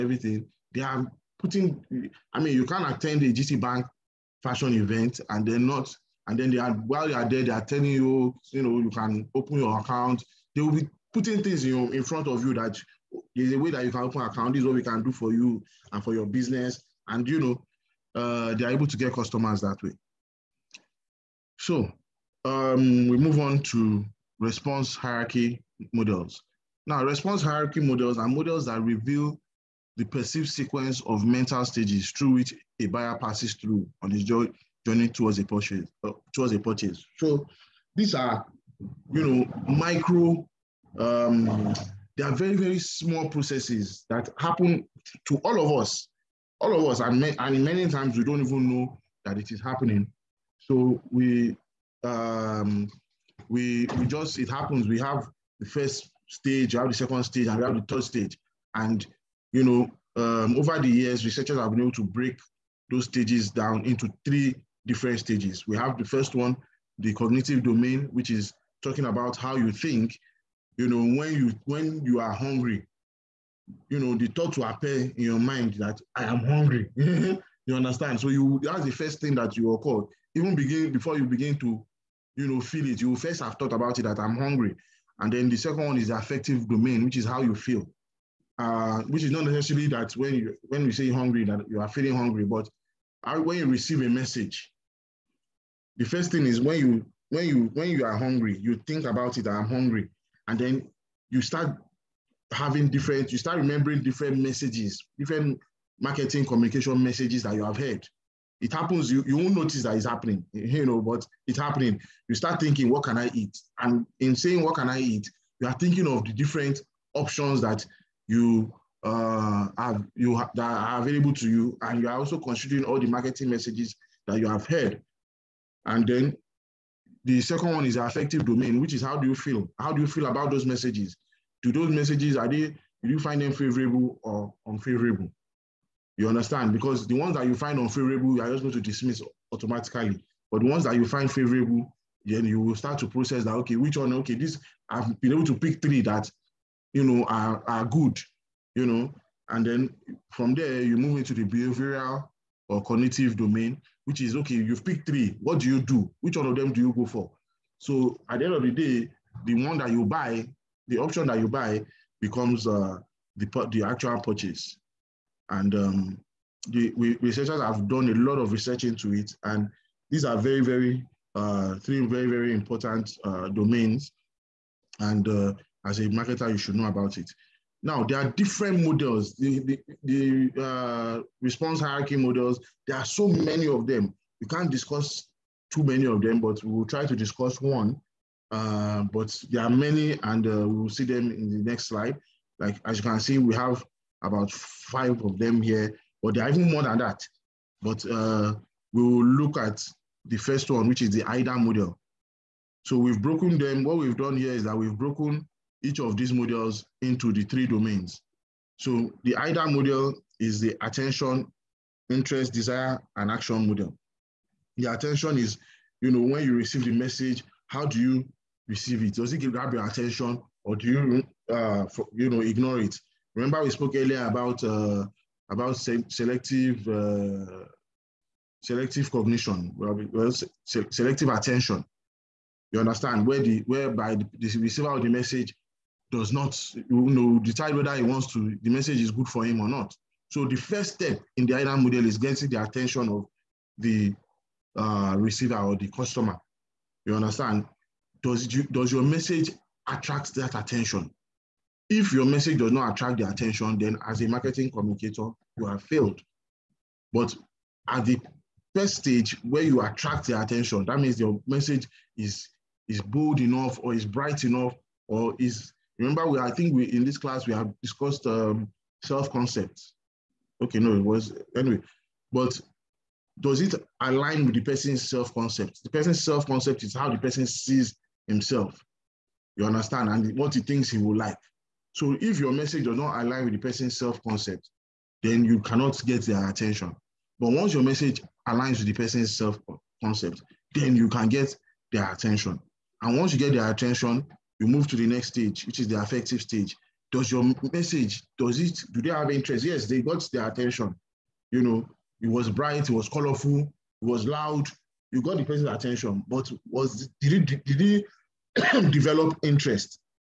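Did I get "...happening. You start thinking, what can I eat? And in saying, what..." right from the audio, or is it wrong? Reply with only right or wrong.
right.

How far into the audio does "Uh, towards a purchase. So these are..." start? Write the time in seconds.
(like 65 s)
36 s.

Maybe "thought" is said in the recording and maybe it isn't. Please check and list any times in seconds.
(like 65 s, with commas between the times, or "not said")
74 s, 83 s.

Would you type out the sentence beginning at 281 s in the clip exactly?
So if your message does not align with the person's self-concept, then you cannot get their attention.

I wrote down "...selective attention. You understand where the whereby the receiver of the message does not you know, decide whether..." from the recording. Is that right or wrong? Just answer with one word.
right.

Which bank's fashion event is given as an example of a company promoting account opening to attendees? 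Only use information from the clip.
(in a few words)
GT Bank.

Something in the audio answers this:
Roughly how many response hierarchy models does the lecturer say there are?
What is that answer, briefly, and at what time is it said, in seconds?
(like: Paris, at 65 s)
5, at 194 s.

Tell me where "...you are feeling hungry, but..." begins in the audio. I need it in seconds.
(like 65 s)
91 s.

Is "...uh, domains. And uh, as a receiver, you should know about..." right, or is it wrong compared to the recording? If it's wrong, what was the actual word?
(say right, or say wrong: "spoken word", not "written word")
wrong: "marketer", not "receiver".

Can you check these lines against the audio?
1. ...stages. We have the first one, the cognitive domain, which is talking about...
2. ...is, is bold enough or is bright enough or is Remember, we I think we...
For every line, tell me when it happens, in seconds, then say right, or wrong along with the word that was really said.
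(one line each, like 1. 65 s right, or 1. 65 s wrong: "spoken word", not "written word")
1. 65 s right
2. 262 s right.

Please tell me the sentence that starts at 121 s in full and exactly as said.
And you are also considering all the marketing messages that you have heard.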